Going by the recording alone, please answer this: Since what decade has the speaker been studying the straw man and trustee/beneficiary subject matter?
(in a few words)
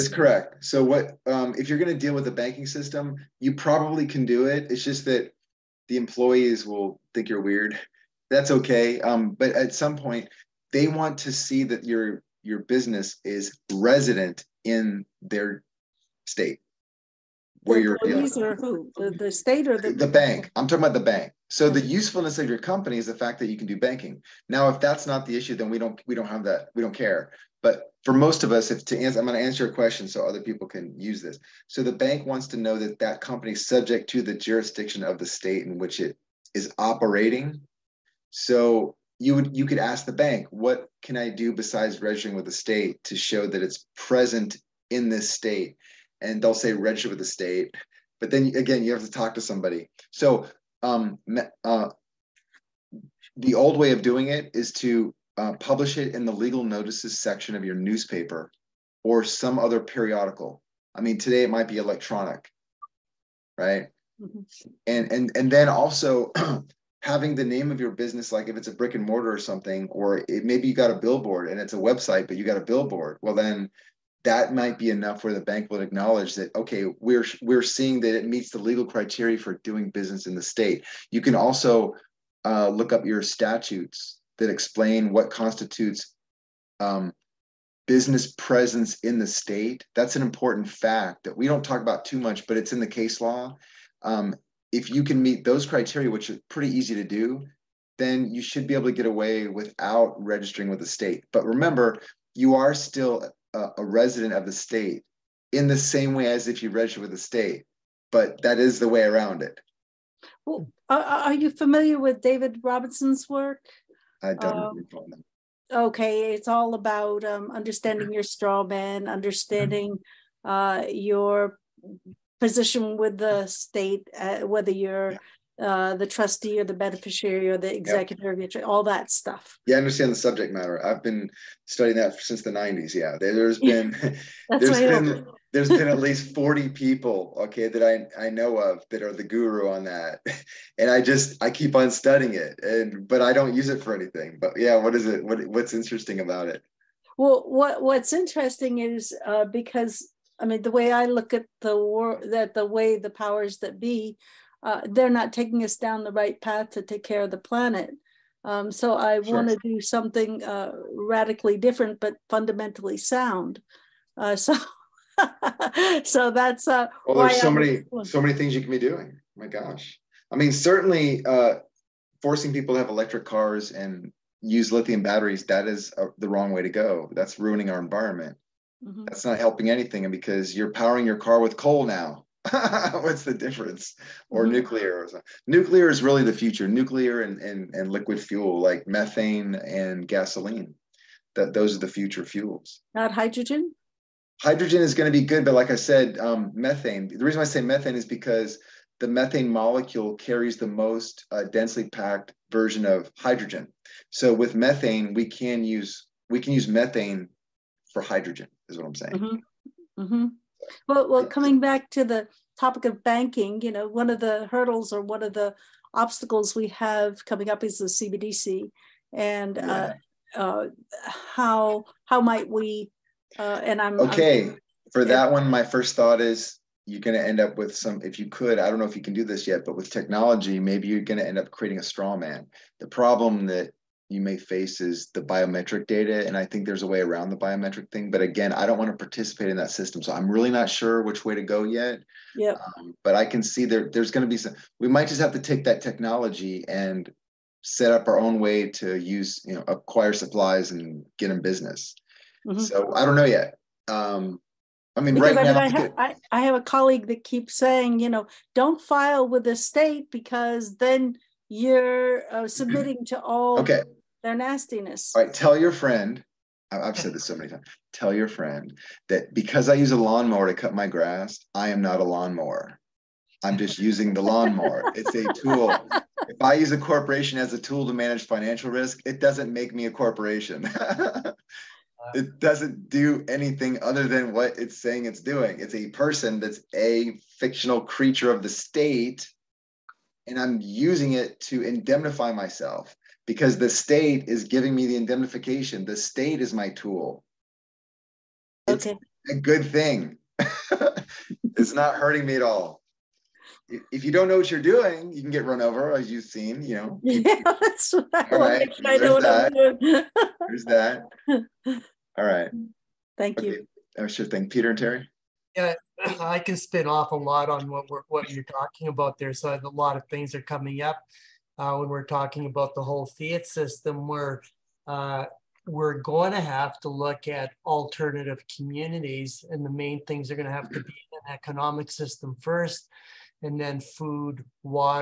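the 90s.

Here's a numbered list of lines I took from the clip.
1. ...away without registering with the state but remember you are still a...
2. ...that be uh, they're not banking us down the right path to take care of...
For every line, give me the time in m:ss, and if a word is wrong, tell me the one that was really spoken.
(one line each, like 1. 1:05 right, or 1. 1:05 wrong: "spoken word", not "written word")
1. 1:39 right
2. 2:33 wrong: "taking", not "banking".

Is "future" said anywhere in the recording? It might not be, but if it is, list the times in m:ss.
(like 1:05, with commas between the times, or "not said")
3:06, 3:11.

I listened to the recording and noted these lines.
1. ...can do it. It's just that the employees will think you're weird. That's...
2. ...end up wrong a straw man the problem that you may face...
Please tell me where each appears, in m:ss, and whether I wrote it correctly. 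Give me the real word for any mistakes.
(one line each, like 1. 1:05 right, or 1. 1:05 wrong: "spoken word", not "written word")
1. 0:04 right
2. 3:51 wrong: "creating", not "wrong".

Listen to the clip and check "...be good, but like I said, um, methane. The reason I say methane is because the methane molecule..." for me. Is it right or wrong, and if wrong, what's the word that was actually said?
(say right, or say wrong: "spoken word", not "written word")
right.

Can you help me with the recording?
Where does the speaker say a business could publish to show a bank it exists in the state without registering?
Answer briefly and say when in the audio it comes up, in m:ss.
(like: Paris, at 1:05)
legal notices section, at 0:56.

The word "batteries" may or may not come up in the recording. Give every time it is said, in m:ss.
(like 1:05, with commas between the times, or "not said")
2:55.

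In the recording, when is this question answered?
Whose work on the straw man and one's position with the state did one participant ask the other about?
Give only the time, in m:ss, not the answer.
1:52.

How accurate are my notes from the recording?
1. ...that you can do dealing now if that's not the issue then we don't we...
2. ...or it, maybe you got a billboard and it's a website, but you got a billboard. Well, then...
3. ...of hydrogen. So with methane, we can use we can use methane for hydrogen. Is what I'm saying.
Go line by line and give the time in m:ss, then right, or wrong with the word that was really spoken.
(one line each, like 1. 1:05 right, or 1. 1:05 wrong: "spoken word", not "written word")
1. 0:23 wrong: "banking", not "dealing"
2. 1:09 right
3. 3:22 right.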